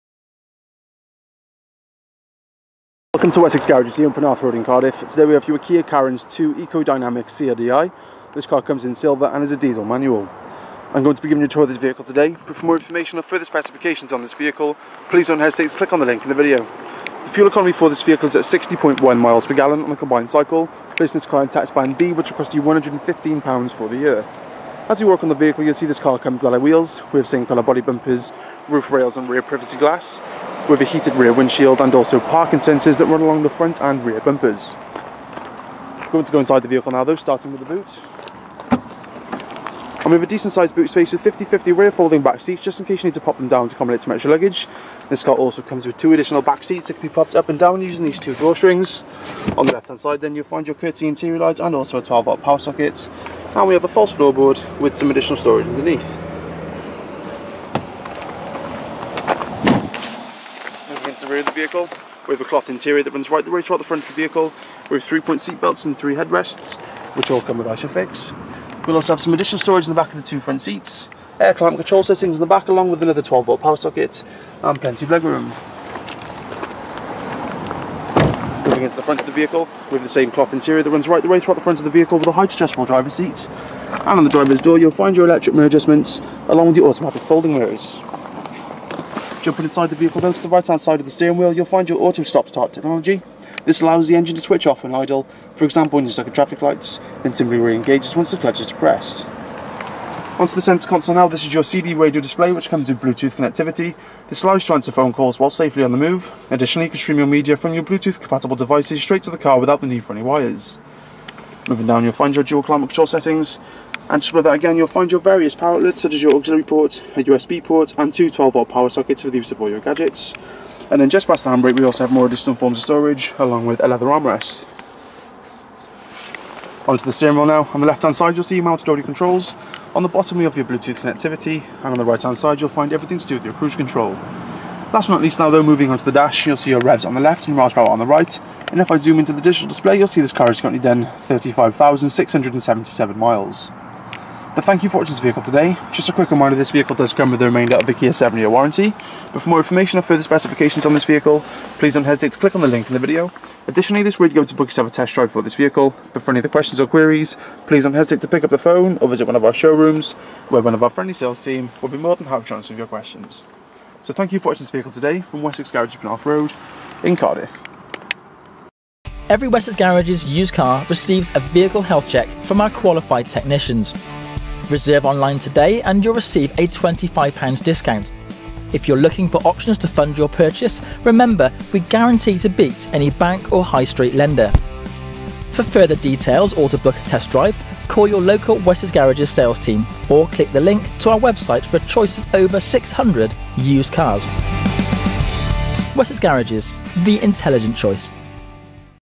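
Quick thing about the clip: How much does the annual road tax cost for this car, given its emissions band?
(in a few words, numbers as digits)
£115.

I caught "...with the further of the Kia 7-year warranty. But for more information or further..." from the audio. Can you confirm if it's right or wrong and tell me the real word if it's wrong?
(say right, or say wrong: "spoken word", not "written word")
wrong: "remainder", not "further".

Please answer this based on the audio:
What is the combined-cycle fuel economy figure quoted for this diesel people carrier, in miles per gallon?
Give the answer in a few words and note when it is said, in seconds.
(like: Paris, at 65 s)
60.1, at 18 s.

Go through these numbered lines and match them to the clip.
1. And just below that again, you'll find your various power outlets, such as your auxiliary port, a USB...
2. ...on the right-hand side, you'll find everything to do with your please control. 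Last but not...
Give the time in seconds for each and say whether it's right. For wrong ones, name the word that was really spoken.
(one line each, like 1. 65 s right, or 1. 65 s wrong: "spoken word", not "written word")
1. 114 s right
2. 131 s wrong: "cruise", not "please".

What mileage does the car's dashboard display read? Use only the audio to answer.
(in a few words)
35,677.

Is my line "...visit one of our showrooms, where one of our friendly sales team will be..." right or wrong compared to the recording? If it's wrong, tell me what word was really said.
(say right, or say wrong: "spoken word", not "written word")
right.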